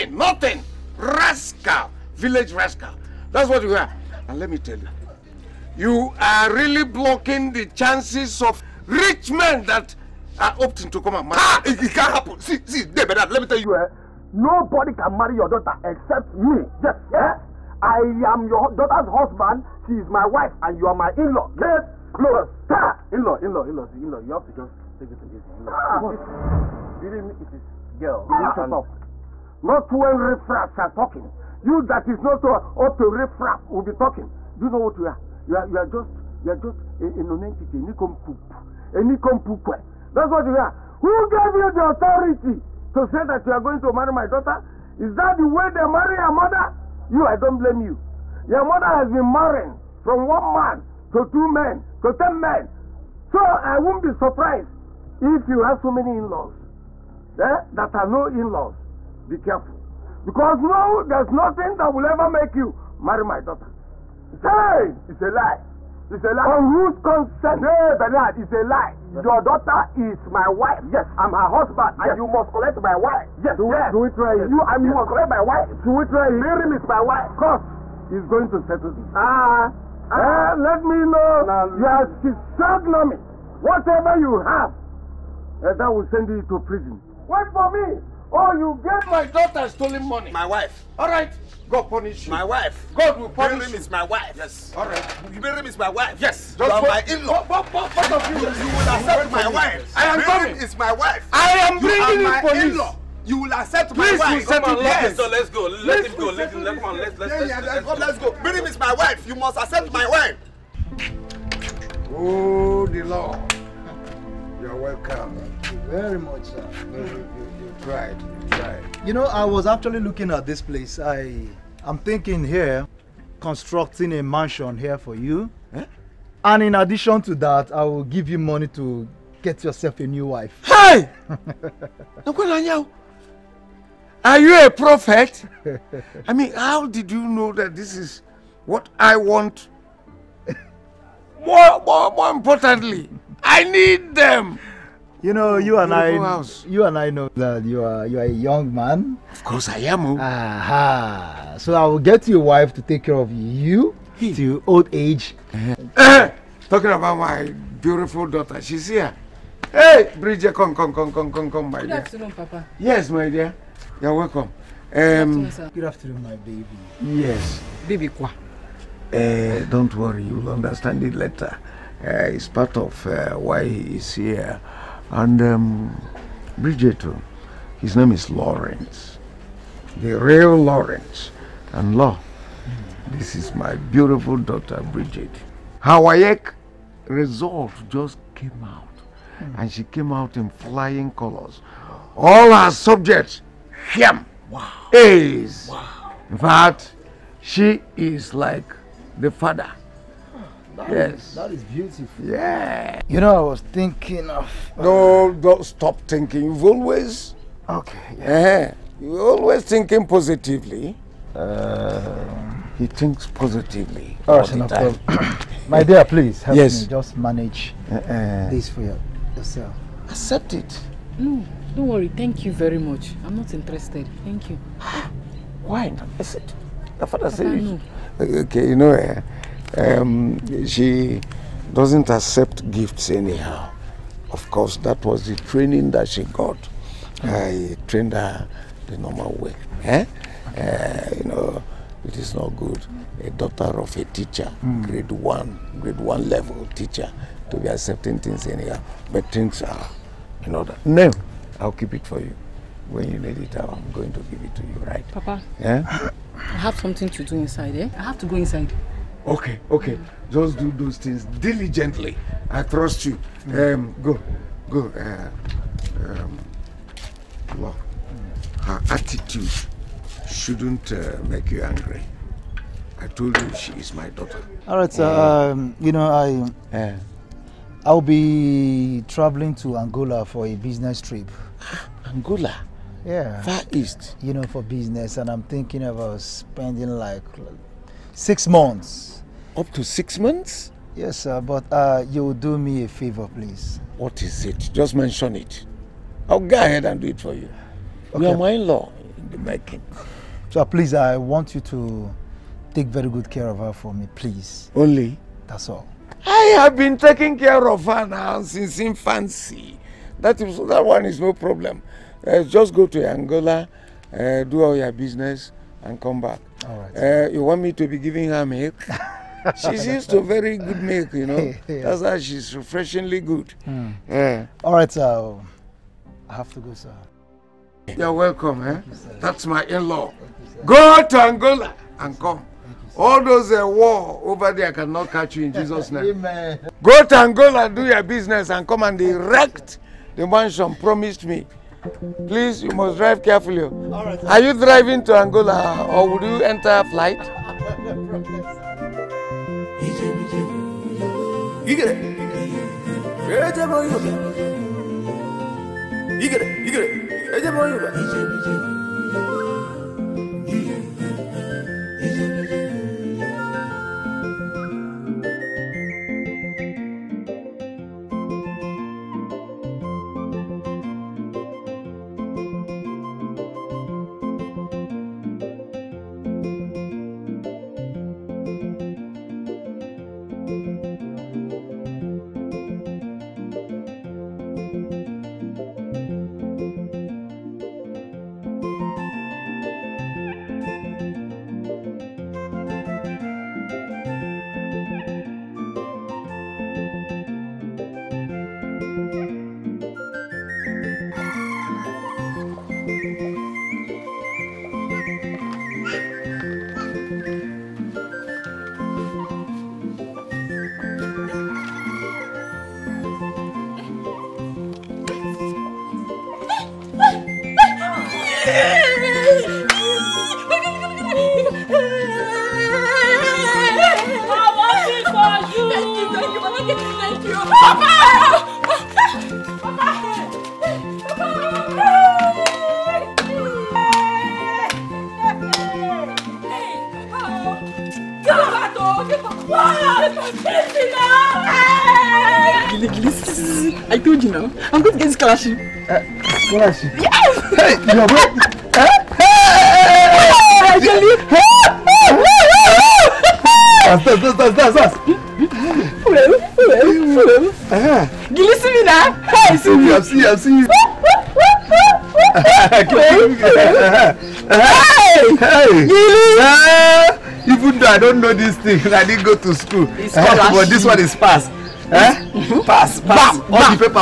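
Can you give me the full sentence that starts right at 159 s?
Hey, Bridget, come, come, come, come, come, come, my Good dear.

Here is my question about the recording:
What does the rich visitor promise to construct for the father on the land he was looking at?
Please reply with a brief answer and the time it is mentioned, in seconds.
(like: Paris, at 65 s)
A mansion, at 124 s.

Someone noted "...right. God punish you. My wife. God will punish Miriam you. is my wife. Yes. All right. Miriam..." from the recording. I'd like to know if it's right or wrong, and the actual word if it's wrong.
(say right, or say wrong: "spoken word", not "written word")
right.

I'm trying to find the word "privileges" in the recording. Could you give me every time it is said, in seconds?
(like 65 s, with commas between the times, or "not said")
not said.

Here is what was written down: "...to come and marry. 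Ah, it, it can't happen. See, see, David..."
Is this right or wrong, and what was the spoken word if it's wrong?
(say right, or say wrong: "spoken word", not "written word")
right.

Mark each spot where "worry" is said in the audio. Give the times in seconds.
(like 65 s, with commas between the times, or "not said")
169 s, 221 s.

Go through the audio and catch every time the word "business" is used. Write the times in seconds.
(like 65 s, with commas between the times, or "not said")
280 s, 284 s, 314 s, 338 s.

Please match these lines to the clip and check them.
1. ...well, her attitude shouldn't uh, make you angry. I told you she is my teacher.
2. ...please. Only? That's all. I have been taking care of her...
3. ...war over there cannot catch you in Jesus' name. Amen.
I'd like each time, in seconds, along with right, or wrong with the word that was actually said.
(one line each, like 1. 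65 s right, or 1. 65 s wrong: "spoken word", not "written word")
1. 267 s wrong: "daughter", not "teacher"
2. 304 s right
3. 333 s right.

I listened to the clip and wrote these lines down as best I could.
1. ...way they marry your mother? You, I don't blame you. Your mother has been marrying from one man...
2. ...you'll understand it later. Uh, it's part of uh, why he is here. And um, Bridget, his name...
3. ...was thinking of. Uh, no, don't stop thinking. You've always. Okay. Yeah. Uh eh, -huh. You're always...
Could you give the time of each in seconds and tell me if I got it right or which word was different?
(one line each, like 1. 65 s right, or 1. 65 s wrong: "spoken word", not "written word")
1. 45 s right
2. 170 s right
3. 203 s right.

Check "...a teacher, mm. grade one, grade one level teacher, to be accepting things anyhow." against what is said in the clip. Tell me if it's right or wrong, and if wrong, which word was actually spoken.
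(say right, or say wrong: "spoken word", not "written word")
right.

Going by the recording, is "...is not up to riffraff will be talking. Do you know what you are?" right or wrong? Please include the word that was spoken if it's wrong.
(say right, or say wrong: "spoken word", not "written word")
right.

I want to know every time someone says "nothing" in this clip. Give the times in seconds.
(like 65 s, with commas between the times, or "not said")
0 s, 61 s.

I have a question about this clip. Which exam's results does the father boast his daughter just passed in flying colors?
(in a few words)
WAEC.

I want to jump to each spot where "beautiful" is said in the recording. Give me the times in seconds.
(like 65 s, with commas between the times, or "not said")
157 s, 183 s, 201 s.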